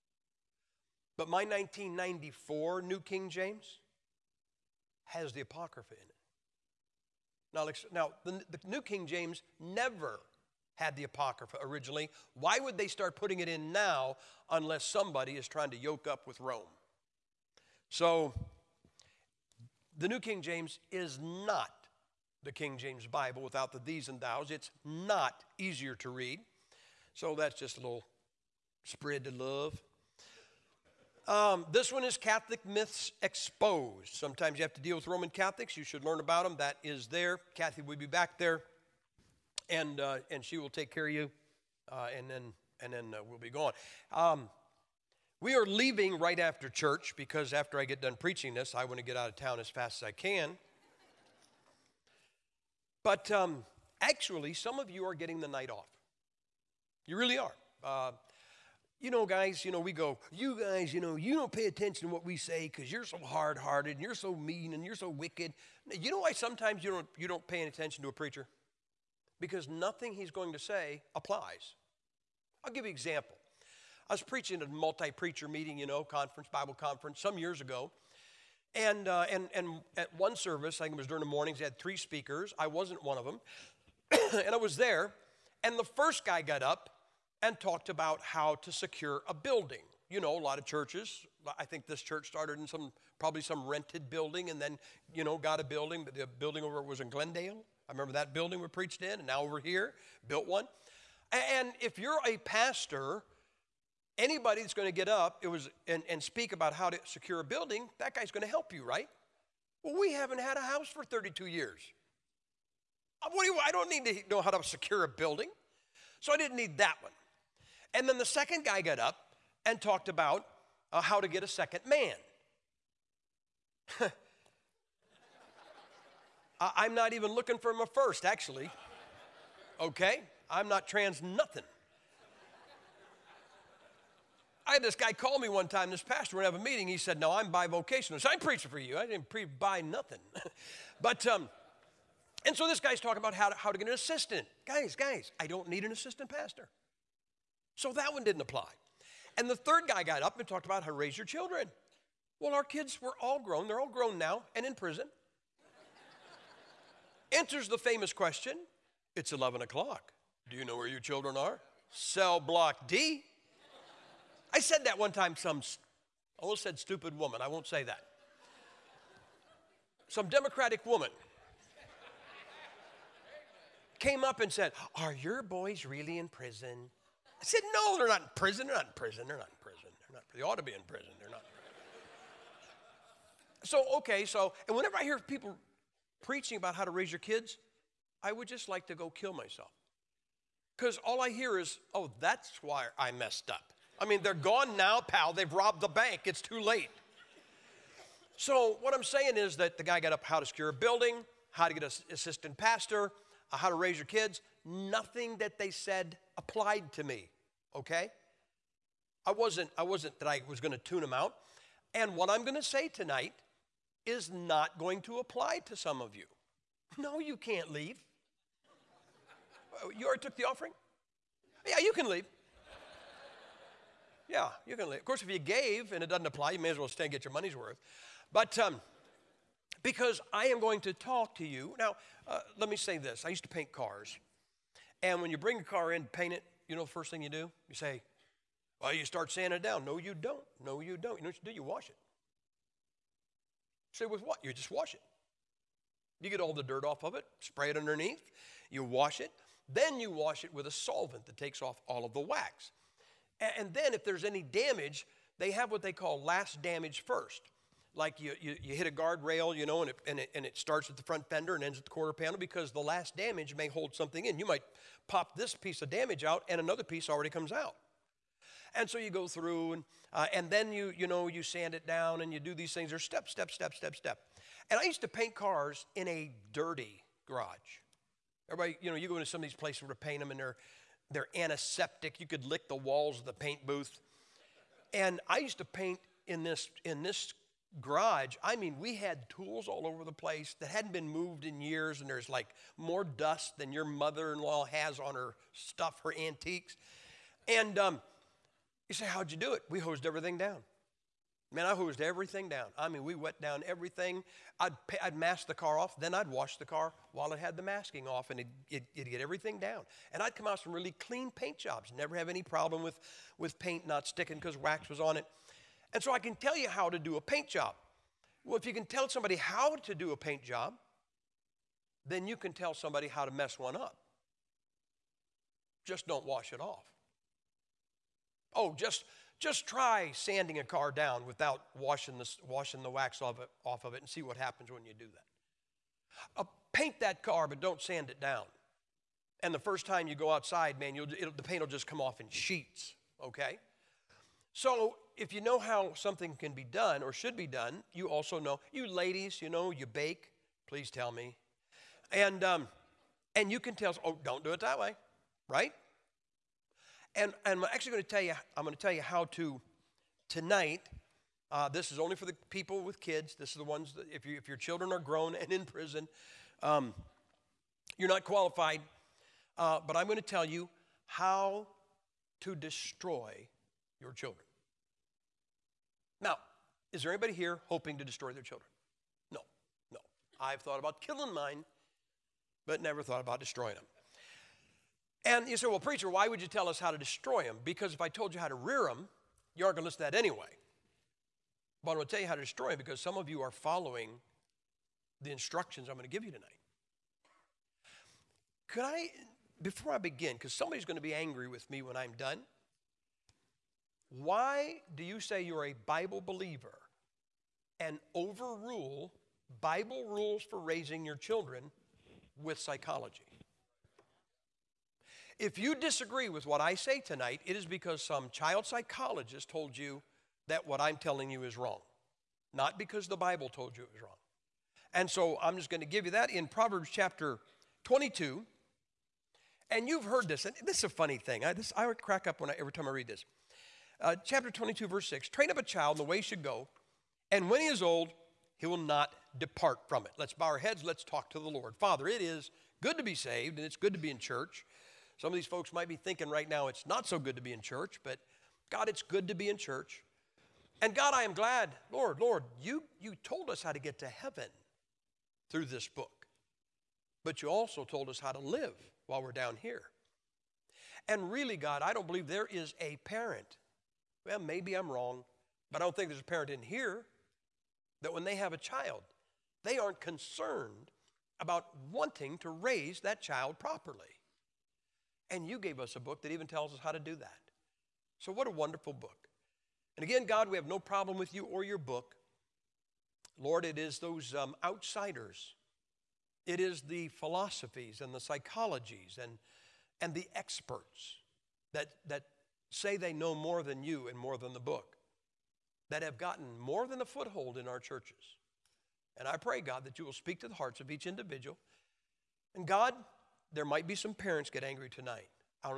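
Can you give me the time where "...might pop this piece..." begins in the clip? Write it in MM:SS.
04:24.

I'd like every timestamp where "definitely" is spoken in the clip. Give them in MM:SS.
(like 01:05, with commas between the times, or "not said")
not said.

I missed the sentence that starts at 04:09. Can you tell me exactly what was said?
Then you wash it with a solvent that takes off all of the wax.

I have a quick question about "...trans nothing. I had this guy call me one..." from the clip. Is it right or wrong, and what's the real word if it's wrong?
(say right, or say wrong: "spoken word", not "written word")
right.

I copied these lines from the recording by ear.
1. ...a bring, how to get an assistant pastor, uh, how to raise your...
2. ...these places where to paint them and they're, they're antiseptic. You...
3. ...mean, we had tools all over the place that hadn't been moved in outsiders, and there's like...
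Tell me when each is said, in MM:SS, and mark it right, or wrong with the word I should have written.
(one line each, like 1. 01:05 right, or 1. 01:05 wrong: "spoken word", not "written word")
1. 03:20 wrong: "building", not "bring"
2. 04:39 right
3. 04:48 wrong: "years", not "outsiders".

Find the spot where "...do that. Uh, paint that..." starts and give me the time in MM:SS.
05:34.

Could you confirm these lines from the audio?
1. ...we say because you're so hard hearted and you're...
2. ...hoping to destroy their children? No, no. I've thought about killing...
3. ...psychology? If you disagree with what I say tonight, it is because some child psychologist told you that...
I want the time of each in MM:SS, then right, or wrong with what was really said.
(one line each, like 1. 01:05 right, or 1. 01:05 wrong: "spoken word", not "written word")
1. 01:02 right
2. 06:17 right
3. 06:52 right.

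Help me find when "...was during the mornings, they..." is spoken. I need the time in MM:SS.
01:20.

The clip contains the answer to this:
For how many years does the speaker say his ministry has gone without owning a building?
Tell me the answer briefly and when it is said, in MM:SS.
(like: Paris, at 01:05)
32, at 01:51.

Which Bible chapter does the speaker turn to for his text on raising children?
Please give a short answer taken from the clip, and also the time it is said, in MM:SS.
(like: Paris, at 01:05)
Proverbs 22, at 07:06.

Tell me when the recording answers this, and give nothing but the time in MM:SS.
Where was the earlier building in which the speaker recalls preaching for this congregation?
01:37.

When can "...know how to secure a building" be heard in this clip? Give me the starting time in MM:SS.
01:54.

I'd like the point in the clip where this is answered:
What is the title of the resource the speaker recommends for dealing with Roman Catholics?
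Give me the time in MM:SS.
00:32.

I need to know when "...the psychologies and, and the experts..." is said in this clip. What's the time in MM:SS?
08:08.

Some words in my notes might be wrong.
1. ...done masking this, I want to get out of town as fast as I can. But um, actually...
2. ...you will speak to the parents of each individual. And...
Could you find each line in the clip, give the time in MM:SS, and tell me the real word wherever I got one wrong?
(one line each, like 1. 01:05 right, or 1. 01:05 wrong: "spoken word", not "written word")
1. 00:48 wrong: "preaching", not "masking"
2. 08:19 wrong: "hearts", not "parents".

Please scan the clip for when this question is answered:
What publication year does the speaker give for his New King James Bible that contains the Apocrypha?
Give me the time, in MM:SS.
00:01.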